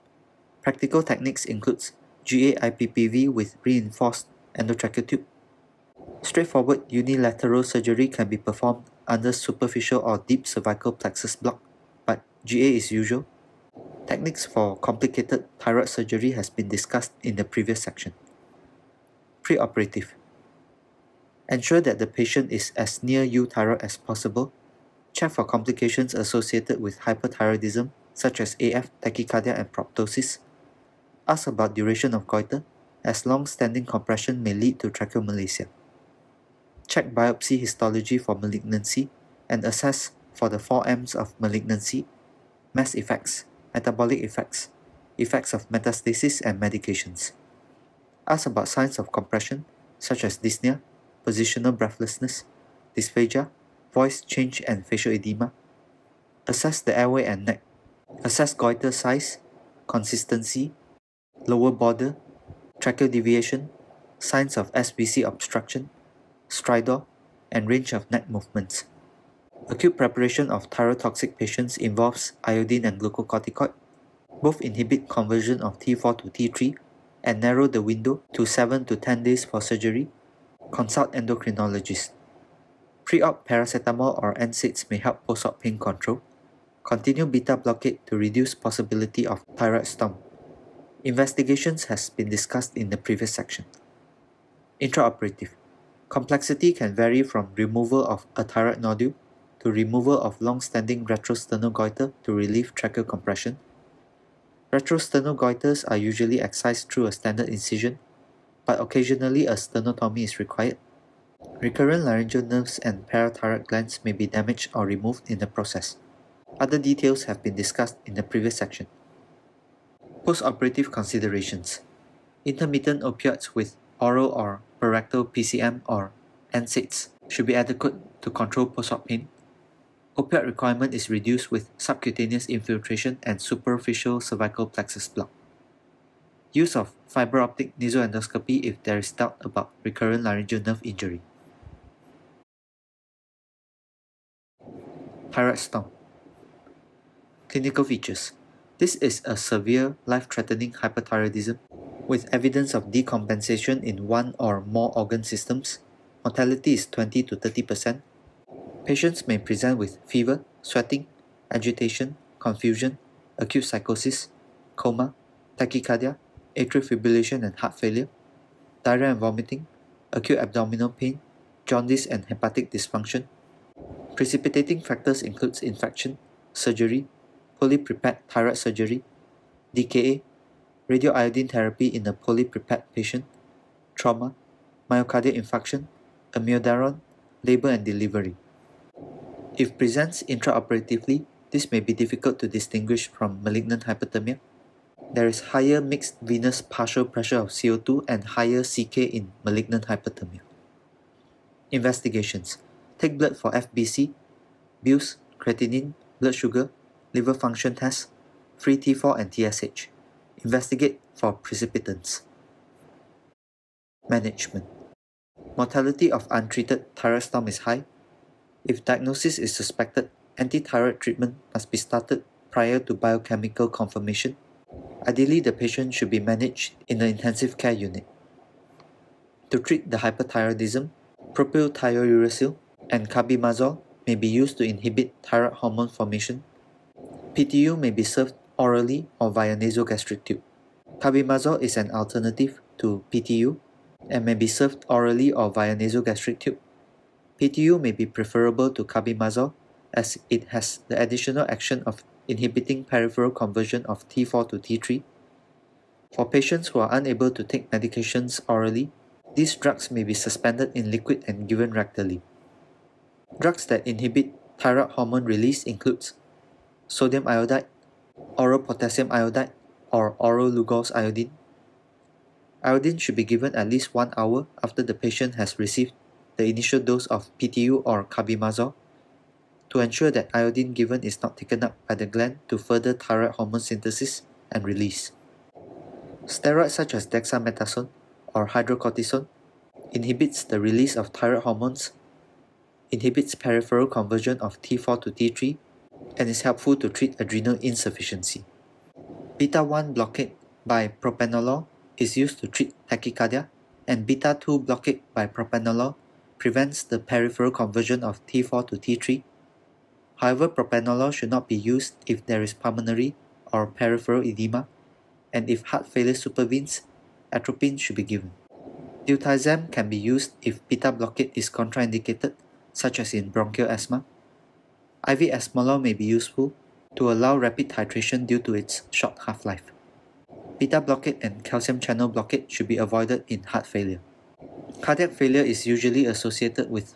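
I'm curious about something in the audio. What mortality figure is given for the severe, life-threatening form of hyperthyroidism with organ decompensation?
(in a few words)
20 to 30 percent.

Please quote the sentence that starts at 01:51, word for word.
Recurrent laryngeal nerves and parathyroid glands may be damaged or removed in the process.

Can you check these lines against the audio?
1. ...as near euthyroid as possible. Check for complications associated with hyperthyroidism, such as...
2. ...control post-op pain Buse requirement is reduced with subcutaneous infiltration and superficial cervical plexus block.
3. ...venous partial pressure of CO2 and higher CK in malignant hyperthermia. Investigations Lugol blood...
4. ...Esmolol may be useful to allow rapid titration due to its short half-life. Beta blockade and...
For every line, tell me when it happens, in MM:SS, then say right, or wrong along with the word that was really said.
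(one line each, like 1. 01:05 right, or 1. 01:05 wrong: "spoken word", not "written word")
1. 00:22 right
2. 02:08 wrong: "Opioid", not "Buse"
3. 03:16 wrong: "Take", not "Lugol"
4. 05:25 right.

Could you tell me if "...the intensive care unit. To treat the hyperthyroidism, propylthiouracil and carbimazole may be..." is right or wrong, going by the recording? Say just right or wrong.
right.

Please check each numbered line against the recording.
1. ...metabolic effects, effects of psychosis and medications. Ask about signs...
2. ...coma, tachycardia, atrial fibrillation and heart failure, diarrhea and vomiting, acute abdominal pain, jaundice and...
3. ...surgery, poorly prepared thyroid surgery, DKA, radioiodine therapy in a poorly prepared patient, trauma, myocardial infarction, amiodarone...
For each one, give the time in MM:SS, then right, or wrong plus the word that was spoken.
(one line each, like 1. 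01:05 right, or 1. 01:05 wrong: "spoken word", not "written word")
1. 00:43 wrong: "metastasis", not "psychosis"
2. 02:44 right
3. 02:56 right.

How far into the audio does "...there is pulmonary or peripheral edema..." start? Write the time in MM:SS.
05:12.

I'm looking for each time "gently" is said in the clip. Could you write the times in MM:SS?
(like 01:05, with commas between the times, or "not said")
not said.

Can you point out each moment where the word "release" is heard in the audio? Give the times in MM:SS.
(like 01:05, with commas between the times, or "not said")
04:25, 04:44, 04:50.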